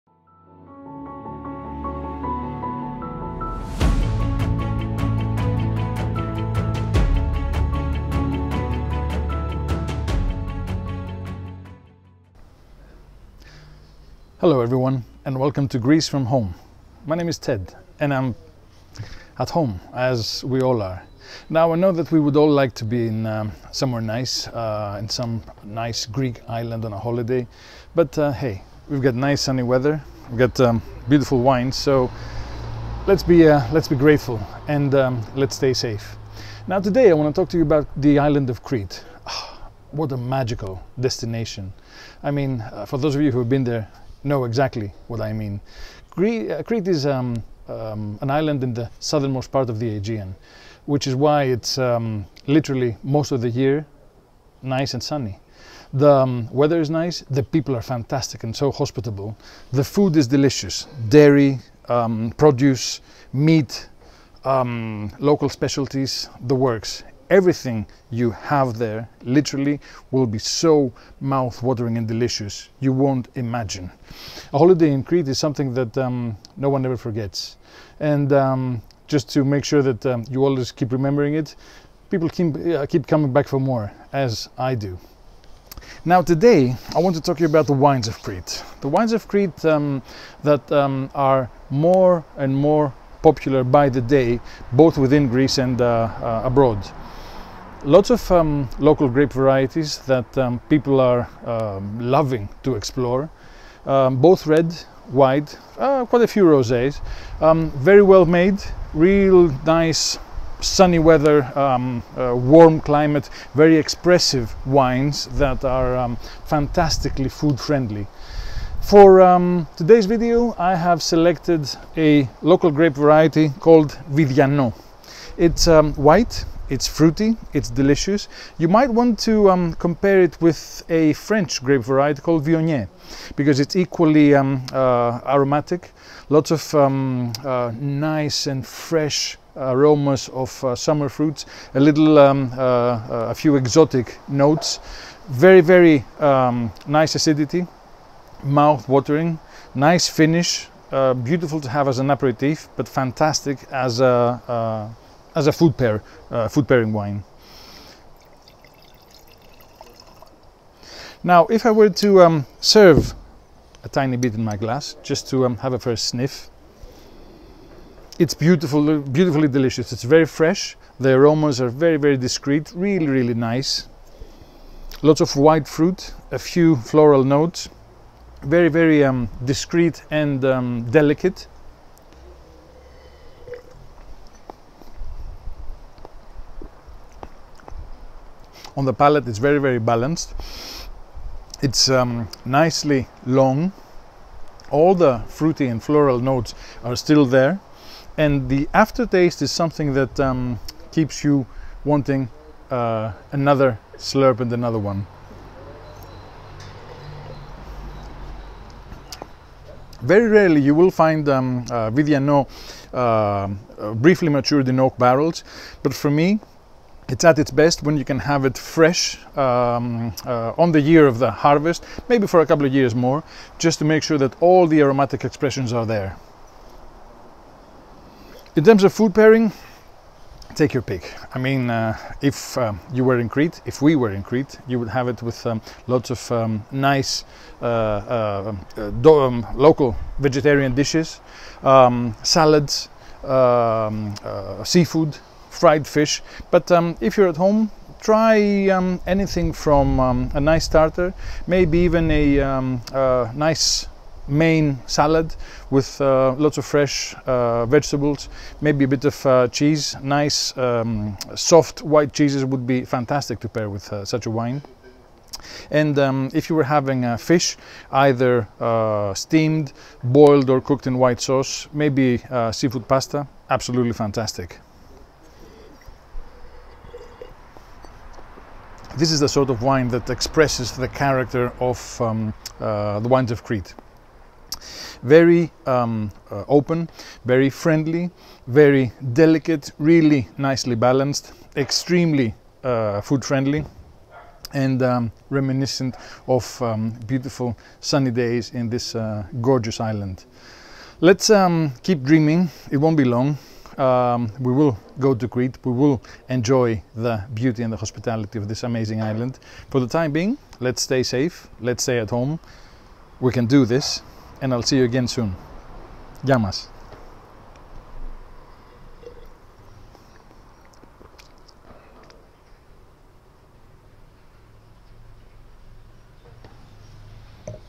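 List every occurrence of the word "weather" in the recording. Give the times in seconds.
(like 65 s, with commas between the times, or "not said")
29 s, 56 s, 110 s.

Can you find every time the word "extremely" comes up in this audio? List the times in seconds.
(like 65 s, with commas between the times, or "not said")
291 s.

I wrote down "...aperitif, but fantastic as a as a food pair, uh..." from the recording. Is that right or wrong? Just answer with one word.
right.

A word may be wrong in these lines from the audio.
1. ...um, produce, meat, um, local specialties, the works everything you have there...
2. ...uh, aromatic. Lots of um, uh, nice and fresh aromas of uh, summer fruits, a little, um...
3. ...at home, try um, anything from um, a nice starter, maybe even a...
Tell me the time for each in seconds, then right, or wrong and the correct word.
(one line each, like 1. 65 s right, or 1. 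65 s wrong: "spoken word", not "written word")
1. 61 s right
2. 134 s right
3. 247 s right.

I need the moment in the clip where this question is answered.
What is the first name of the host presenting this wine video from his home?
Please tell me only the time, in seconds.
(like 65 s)
17 s.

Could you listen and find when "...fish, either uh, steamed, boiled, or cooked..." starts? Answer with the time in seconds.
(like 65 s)
267 s.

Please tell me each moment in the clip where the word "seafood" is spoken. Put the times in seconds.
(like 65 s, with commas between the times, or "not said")
244 s, 272 s.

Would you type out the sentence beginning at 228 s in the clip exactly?
In terms of food pairing, take your pick.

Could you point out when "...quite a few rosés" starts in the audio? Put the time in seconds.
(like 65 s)
106 s.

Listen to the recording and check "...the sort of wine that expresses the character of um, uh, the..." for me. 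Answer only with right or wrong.
right.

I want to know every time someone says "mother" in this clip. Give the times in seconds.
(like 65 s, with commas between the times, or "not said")
not said.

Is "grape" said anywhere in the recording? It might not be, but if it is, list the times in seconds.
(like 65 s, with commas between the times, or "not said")
99 s, 122 s, 131 s.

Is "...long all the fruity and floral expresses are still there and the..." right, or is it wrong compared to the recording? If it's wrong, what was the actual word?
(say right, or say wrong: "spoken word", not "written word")
wrong: "notes", not "expresses".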